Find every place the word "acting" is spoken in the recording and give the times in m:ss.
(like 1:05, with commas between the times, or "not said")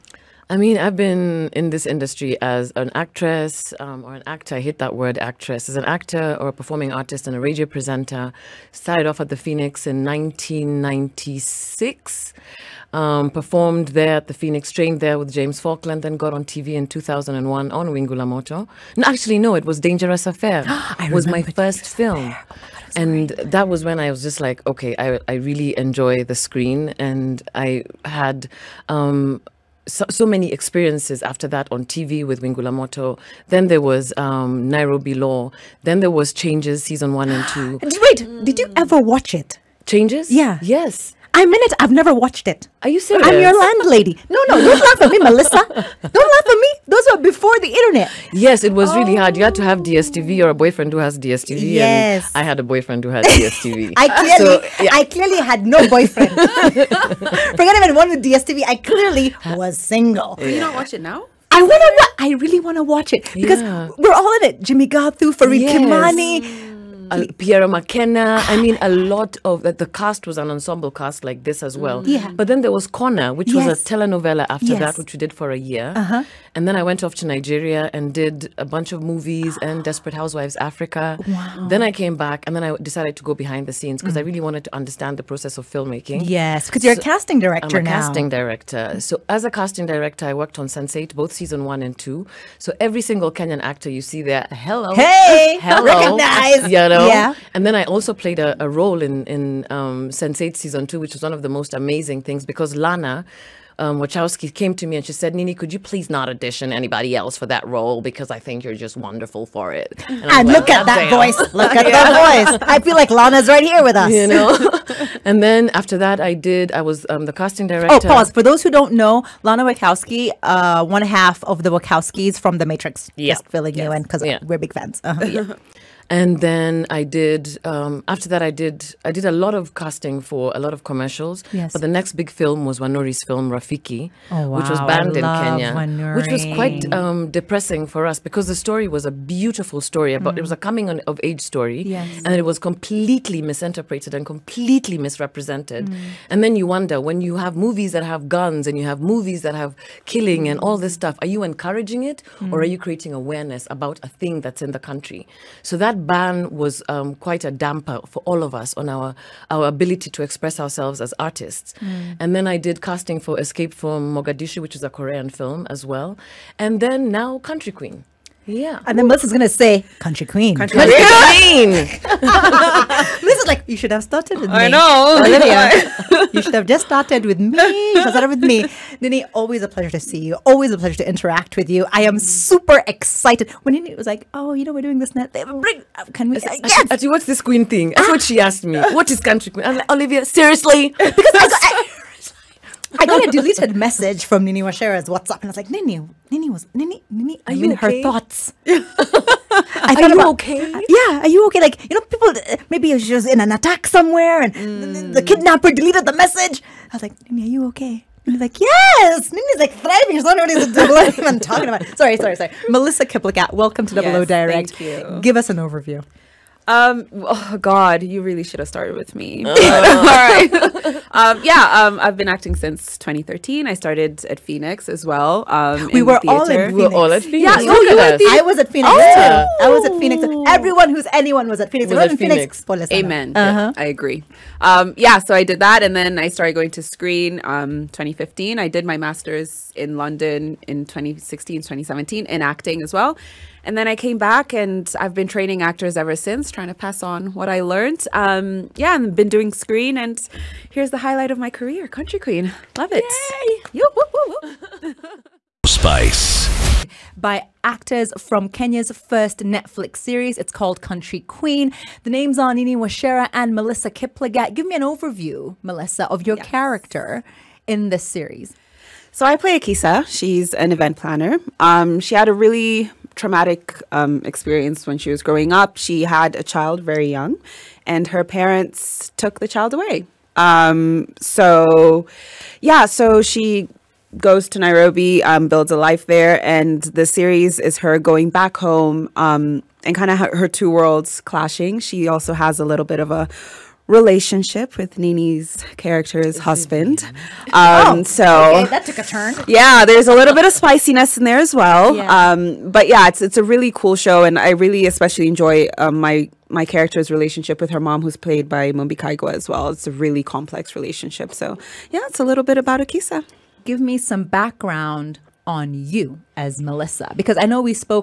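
3:42, 4:02.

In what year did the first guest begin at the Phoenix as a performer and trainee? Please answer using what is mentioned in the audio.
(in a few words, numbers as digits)
1996.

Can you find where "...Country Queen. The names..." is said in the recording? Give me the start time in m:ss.
4:20.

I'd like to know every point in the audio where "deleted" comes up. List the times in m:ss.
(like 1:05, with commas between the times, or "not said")
3:25.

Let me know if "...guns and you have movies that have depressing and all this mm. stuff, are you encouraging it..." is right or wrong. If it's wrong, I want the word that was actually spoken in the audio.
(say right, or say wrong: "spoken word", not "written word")
wrong: "killing", not "depressing".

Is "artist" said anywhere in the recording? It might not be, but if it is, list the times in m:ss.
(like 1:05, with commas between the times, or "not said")
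0:06, 2:41.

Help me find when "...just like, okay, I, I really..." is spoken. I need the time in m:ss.
0:24.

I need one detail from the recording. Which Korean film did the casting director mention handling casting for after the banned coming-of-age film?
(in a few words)
Escape from Mogadishu.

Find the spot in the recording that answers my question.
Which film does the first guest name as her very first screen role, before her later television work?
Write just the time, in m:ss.
0:19.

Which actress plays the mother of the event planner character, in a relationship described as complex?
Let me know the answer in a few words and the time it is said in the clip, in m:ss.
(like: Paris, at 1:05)
Mumbi Kaigwa, at 5:08.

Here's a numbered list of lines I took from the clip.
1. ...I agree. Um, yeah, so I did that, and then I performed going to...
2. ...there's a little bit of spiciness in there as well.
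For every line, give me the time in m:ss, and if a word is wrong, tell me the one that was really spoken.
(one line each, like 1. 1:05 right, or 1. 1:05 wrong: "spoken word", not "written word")
1. 3:53 wrong: "started", not "performed"
2. 4:59 right.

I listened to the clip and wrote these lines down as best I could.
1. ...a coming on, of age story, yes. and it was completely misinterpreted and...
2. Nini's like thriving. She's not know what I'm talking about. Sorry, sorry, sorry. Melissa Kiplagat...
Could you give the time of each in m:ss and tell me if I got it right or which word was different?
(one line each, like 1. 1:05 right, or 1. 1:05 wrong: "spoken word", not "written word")
1. 2:20 right
2. 3:29 right.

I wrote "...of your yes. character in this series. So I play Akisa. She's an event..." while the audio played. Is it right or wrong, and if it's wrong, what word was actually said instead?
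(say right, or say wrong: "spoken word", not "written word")
right.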